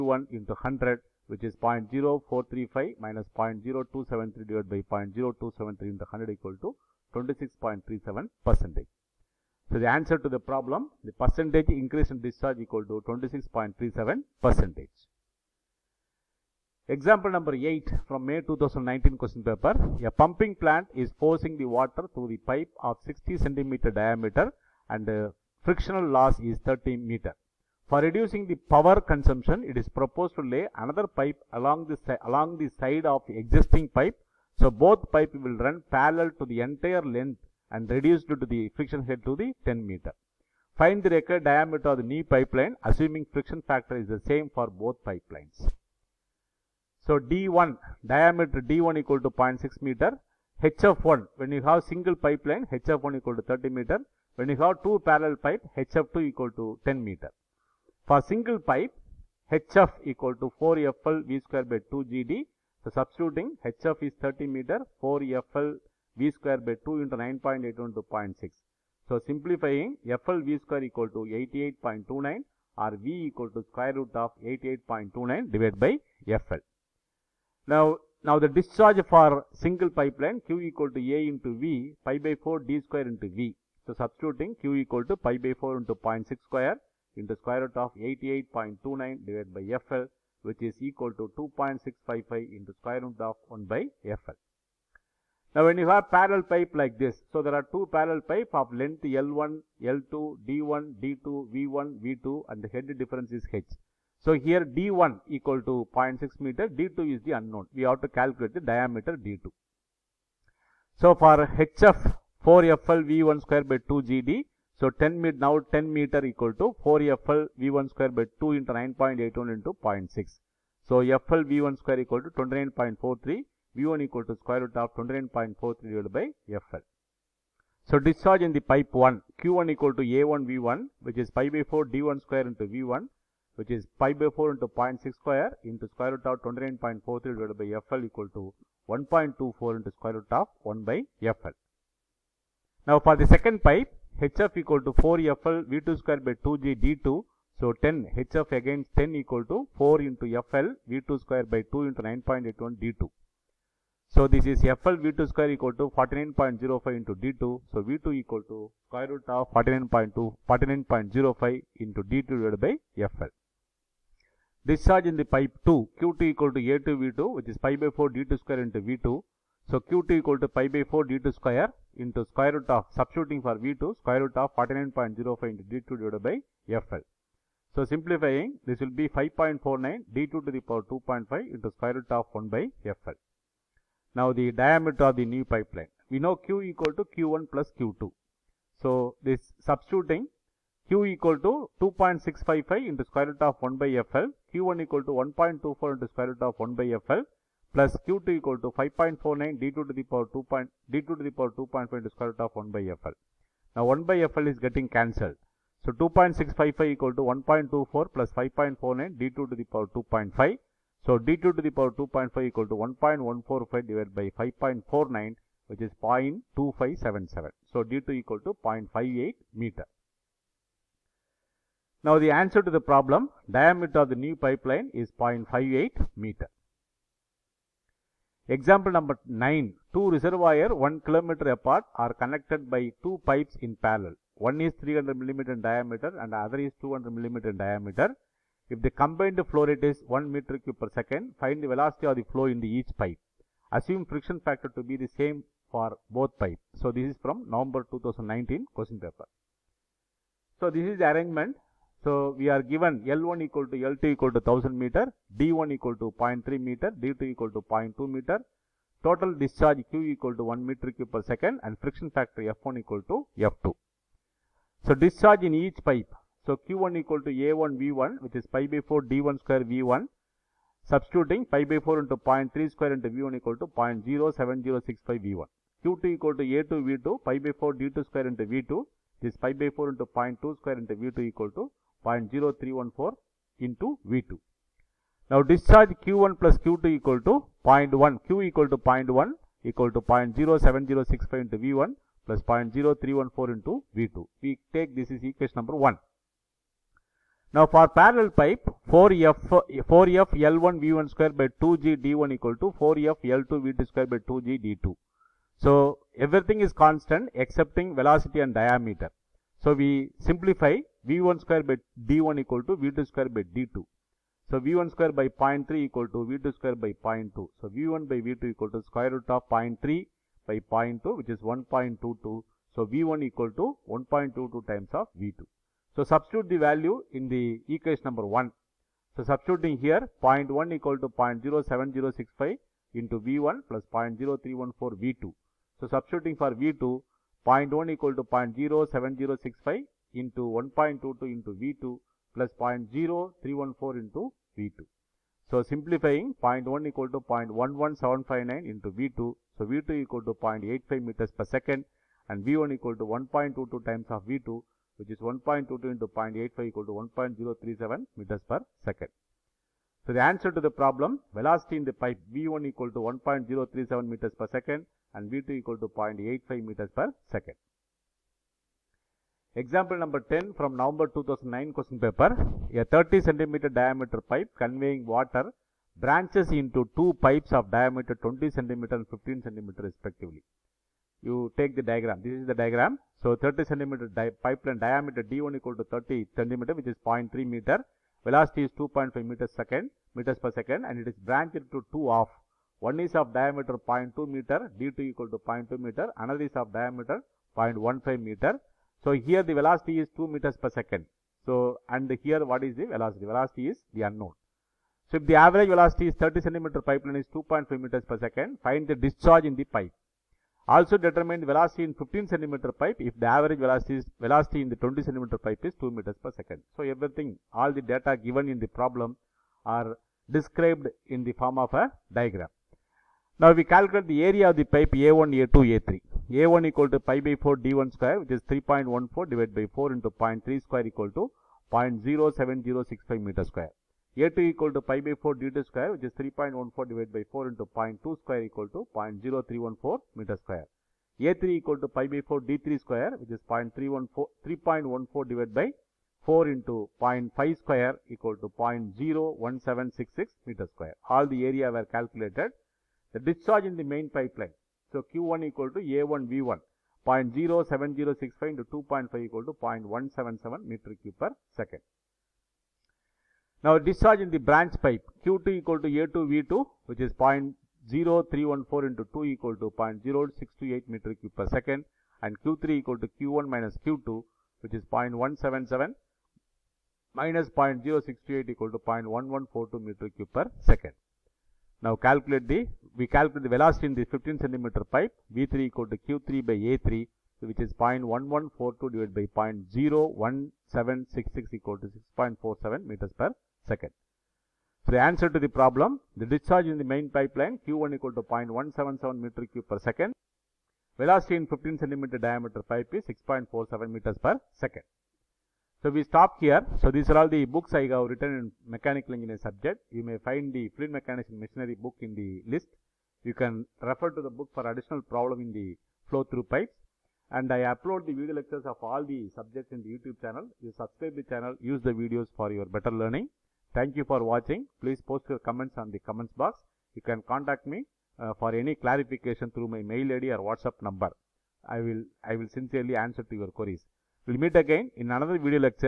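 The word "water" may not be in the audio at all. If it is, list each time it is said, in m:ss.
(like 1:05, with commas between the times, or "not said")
0:21, 6:15.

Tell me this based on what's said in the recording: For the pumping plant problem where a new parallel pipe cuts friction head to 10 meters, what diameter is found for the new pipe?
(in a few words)
0.58 meter.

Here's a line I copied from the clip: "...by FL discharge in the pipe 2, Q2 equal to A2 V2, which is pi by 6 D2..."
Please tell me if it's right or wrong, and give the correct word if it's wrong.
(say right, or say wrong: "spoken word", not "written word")
wrong: "4", not "6".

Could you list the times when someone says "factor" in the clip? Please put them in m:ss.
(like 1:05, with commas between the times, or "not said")
0:43, 4:04, 4:22.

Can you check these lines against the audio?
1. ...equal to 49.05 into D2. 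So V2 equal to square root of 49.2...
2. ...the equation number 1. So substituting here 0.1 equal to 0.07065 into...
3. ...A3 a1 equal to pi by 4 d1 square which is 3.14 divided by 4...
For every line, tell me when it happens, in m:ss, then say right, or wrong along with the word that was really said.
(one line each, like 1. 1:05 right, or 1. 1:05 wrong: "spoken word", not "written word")
1. 2:35 right
2. 5:27 right
3. 7:05 right.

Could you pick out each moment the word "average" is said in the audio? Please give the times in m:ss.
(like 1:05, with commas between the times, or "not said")
6:45, 6:53.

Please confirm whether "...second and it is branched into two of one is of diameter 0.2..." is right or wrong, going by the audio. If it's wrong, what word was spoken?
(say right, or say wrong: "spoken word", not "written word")
right.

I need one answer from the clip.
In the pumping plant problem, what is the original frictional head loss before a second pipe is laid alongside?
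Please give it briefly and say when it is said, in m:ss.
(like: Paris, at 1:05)
30 meters, at 0:25.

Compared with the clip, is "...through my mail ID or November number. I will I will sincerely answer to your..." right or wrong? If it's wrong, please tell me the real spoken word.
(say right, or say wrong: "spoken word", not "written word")
wrong: "WhatsApp", not "November".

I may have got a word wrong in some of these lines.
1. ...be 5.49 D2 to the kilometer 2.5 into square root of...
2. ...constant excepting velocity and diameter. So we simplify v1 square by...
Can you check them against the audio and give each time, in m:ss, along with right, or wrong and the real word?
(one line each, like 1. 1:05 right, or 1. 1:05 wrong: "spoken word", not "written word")
1. 2:58 wrong: "power", not "kilometer"
2. 5:06 right.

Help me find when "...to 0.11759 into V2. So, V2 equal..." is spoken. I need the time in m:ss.
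5:47.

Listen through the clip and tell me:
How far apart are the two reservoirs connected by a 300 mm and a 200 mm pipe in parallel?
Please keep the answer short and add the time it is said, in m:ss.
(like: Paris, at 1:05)
1 kilometer, at 3:50.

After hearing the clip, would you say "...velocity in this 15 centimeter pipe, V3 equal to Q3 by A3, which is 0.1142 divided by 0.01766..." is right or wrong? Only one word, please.
right.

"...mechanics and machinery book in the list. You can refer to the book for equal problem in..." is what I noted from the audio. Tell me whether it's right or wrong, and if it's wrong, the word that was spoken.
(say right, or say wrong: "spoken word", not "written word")
wrong: "additional", not "equal".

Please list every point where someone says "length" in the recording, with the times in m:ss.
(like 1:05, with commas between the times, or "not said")
0:37, 1:38.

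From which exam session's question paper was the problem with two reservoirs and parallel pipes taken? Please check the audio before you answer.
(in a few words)
November 2019.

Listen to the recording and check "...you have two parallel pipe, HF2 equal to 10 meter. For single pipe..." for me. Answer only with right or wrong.
right.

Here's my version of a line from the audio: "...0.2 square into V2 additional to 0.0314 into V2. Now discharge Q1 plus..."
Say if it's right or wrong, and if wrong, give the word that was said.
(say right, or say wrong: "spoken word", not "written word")
wrong: "equal", not "additional".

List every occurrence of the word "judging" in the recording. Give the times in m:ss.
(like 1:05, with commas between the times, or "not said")
not said.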